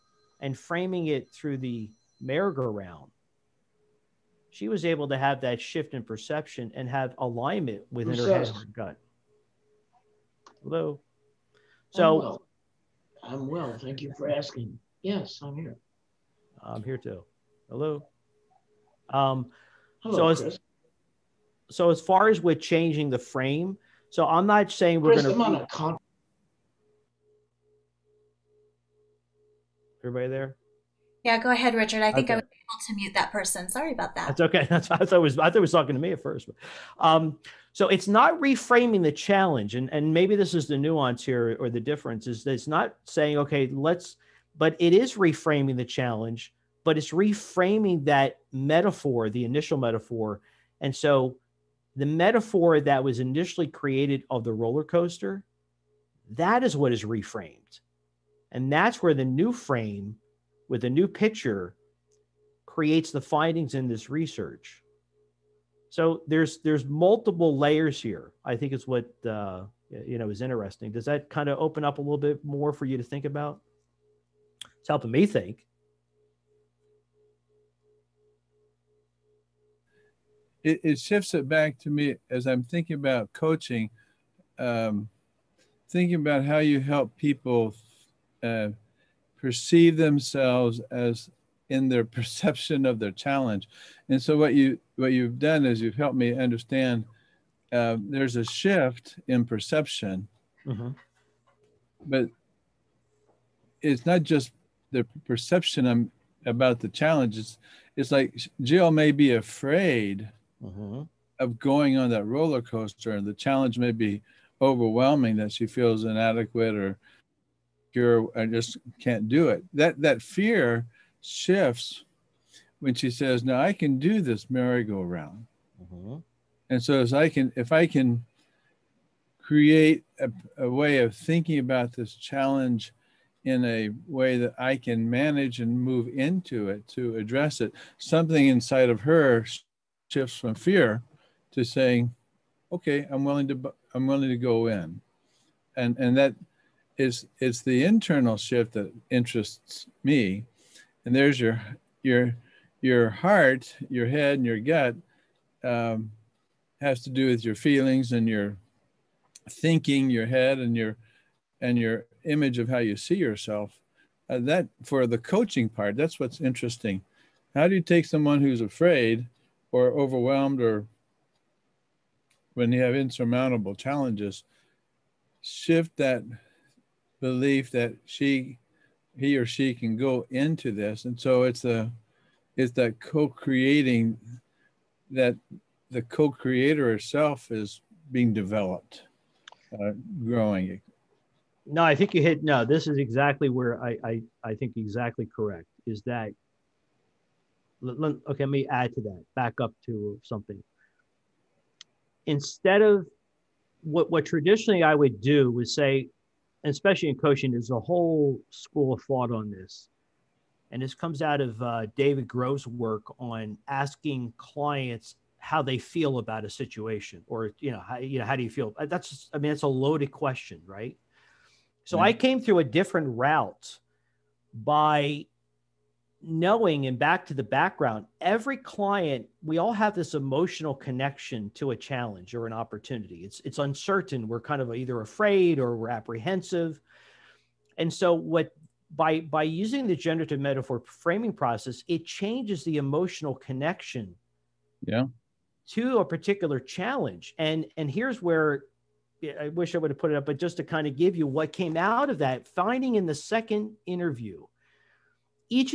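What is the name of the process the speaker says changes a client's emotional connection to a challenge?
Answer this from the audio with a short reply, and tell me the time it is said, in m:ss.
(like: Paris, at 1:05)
generative metaphor framing, at 3:59.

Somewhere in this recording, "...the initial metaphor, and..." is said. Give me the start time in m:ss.
0:49.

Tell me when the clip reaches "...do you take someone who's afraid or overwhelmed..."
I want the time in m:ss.
2:47.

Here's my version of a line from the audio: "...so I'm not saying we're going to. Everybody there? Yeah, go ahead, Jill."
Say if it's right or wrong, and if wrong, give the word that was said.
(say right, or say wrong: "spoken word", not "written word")
wrong: "Richard", not "Jill".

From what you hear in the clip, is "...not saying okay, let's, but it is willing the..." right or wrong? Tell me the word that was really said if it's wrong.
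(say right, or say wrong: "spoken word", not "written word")
wrong: "reframing", not "willing".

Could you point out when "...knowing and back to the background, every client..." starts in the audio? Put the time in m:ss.
3:46.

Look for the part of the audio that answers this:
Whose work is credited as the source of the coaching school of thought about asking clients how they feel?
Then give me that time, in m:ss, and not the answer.
3:31.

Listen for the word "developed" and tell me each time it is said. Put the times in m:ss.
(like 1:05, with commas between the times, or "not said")
3:08.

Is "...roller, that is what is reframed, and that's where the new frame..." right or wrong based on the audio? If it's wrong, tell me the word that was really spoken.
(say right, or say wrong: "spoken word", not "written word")
wrong: "coaster", not "roller".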